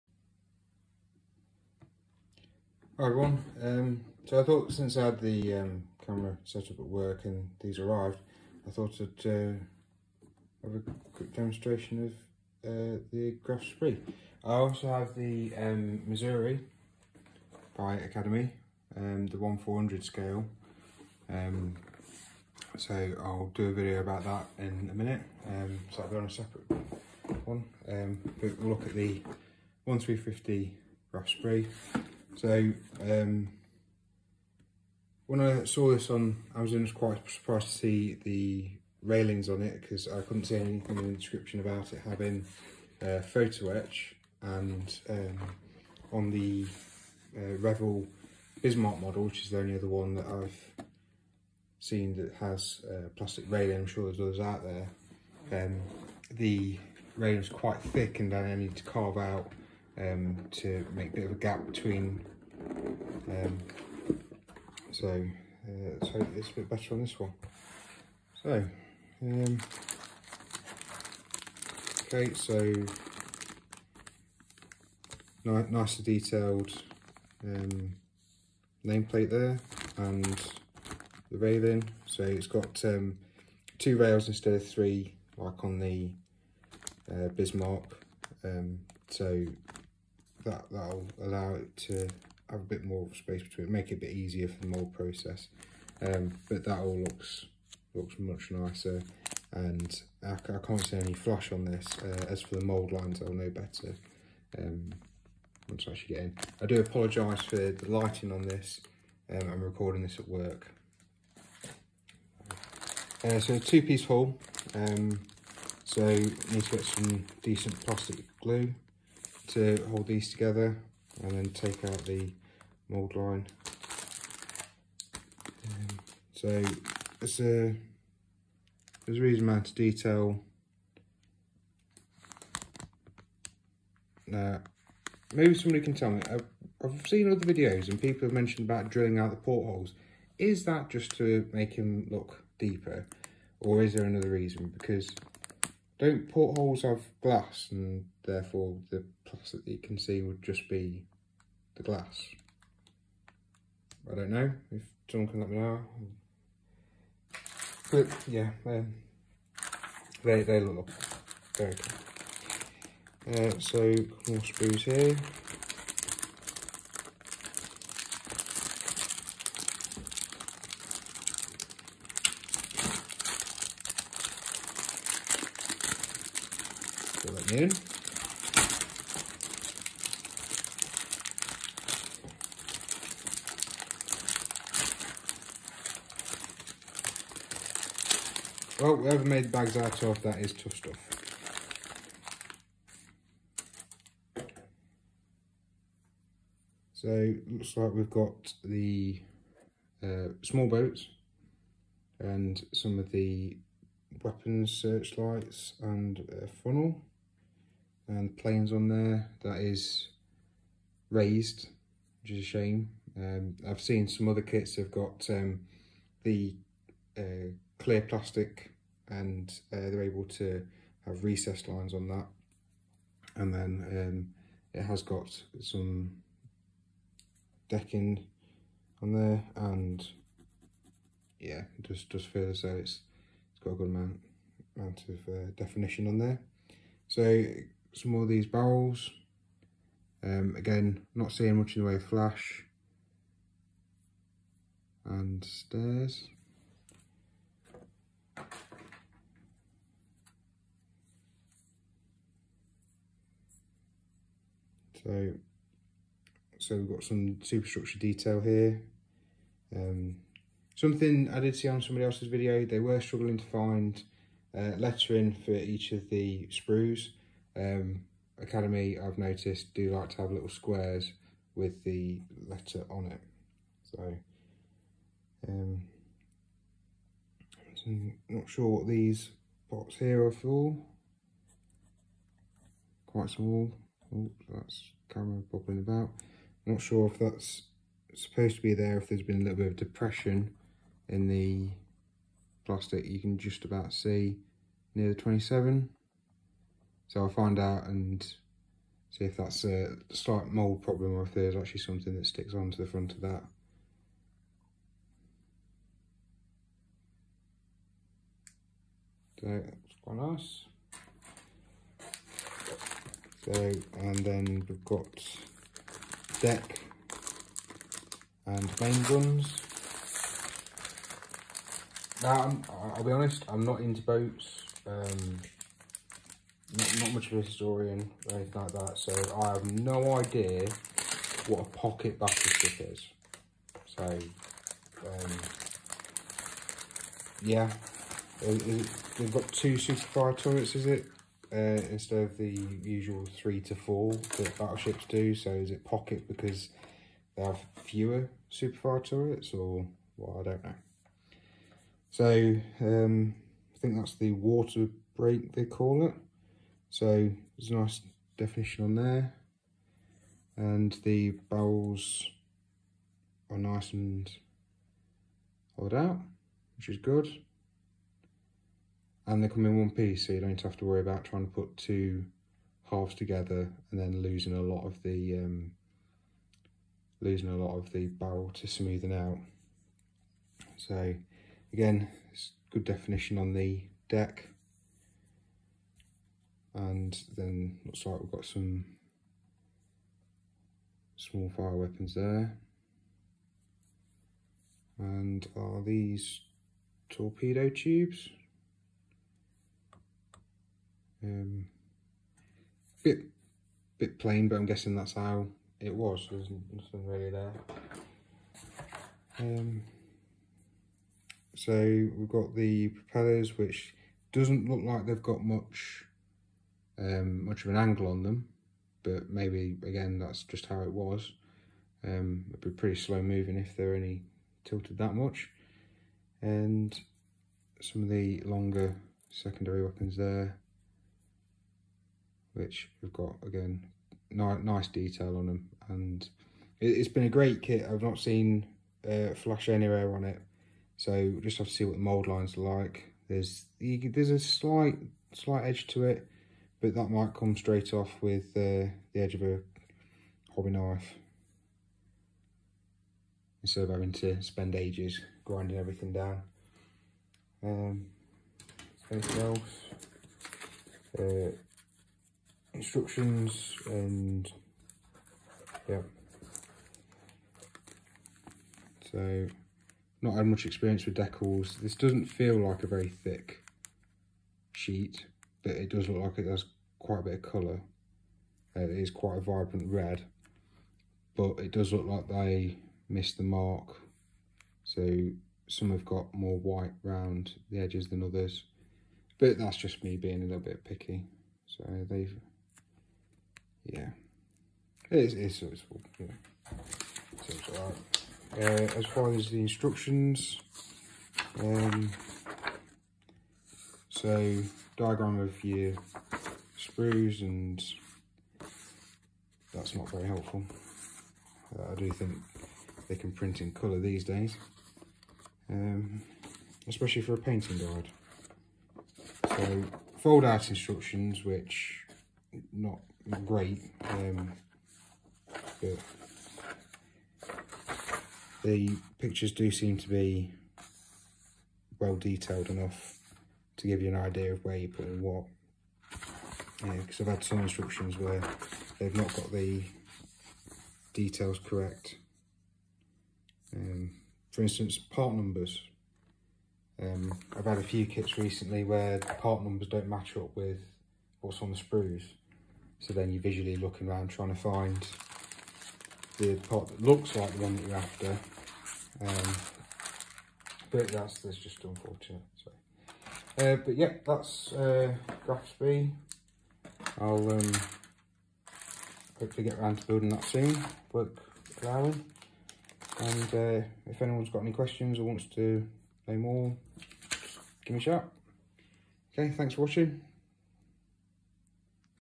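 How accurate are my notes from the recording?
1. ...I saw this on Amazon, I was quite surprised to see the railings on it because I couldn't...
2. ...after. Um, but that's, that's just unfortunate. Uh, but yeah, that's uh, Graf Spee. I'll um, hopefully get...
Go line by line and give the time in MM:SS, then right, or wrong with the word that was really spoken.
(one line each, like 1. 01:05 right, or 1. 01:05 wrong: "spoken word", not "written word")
1. 00:35 right
2. 09:17 right.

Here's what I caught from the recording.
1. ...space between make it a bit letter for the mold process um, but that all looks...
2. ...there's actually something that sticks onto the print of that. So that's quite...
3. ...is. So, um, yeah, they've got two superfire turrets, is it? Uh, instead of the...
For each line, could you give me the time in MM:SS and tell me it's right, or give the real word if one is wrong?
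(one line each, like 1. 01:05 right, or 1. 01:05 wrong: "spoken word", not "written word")
1. 01:33 wrong: "easier", not "letter"
2. 05:01 wrong: "front", not "print"
3. 05:32 right.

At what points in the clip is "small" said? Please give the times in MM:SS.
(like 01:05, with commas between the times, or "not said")
03:20, 04:43, 06:31.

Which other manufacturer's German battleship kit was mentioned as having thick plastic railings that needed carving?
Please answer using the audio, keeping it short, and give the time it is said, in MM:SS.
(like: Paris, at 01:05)
Revell Bismarck, at 00:47.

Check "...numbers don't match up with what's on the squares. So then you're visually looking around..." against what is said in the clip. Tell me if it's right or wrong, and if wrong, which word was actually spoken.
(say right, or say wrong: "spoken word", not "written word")
wrong: "sprues", not "squares".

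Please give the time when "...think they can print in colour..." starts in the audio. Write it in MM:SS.
08:32.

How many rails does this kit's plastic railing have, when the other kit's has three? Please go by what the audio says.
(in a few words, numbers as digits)
2.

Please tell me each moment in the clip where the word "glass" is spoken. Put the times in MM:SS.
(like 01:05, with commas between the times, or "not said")
02:27, 02:31.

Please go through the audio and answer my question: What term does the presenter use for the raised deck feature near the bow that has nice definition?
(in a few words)
Water break.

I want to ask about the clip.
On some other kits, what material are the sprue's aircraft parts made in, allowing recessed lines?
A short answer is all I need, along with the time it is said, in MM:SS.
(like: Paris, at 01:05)
Clear plastic, at 03:37.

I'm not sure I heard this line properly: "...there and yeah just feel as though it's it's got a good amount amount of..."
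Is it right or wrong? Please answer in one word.
right.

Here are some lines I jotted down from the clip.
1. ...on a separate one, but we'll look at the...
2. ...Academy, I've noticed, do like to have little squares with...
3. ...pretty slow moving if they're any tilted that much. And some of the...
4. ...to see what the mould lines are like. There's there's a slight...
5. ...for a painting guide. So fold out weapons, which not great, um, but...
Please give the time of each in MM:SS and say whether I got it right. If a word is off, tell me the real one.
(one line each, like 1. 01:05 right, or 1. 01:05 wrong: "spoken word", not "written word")
1. 00:26 right
2. 04:28 right
3. 07:02 right
4. 07:21 right
5. 08:37 wrong: "instructions", not "weapons".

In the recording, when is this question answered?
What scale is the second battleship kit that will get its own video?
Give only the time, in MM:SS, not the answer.
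00:19.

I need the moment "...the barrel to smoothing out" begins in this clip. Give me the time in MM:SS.
06:17.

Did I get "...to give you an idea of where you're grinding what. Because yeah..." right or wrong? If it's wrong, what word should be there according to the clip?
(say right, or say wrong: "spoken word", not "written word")
wrong: "putting", not "grinding".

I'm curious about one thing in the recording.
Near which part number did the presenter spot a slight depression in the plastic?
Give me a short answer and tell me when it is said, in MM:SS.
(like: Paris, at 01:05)
27, at 04:55.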